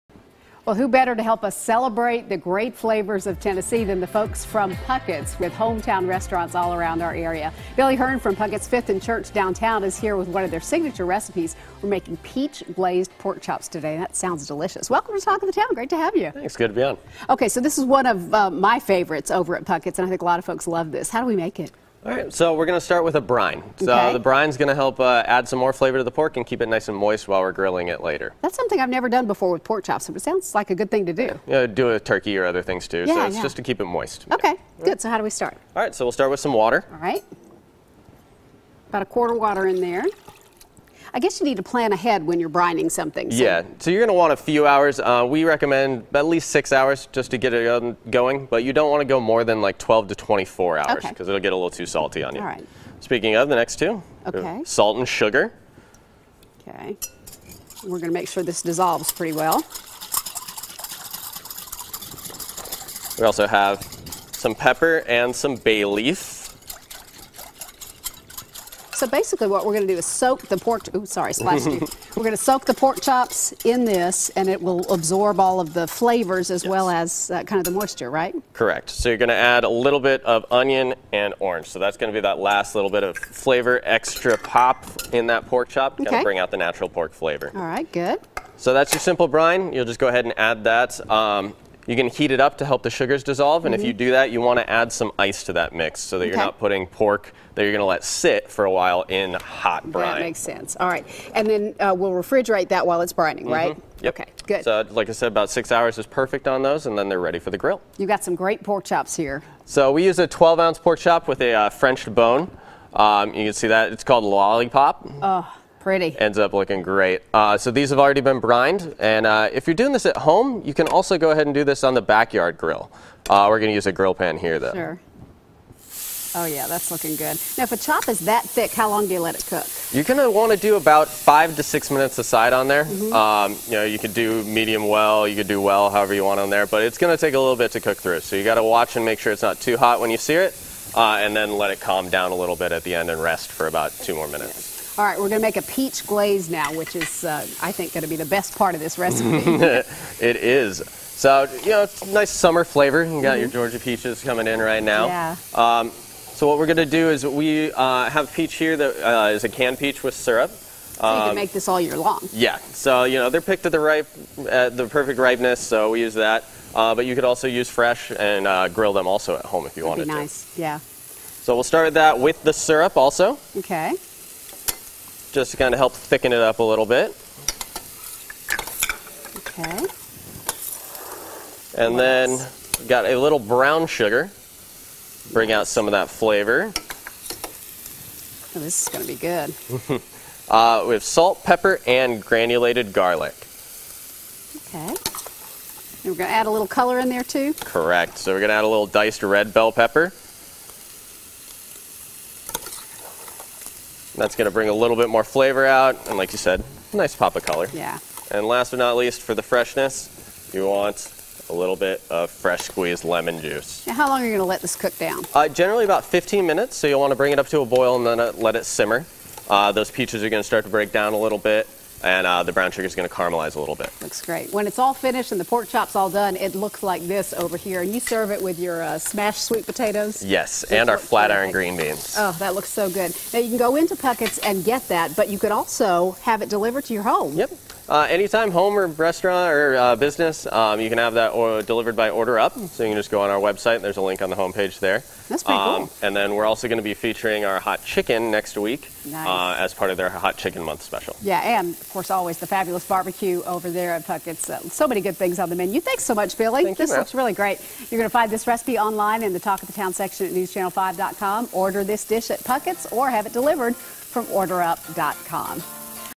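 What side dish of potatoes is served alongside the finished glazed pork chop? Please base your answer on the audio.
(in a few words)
smashed sweet potatoes.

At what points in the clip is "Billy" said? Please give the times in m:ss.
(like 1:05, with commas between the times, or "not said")
0:07, 4:16.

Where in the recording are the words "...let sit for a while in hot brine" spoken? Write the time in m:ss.
1:37.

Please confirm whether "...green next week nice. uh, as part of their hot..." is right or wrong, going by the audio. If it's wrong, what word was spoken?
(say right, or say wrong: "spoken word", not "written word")
wrong: "chicken", not "green".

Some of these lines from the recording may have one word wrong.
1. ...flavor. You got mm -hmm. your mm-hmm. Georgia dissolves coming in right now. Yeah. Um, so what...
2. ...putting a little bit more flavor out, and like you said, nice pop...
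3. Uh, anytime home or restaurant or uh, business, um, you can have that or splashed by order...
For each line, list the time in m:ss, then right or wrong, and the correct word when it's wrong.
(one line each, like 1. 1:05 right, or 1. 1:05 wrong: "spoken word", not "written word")
1. 2:32 wrong: "peaches", not "dissolves"
2. 3:24 wrong: "bring", not "putting"
3. 3:57 wrong: "delivered", not "splashed".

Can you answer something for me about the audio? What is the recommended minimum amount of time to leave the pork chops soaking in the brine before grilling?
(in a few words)
6 hours.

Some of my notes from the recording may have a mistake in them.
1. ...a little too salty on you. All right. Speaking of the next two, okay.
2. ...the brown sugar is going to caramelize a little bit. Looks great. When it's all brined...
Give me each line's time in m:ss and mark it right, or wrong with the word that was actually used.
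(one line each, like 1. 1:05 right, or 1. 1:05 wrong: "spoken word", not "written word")
1. 0:51 right
2. 3:42 wrong: "finished", not "brined".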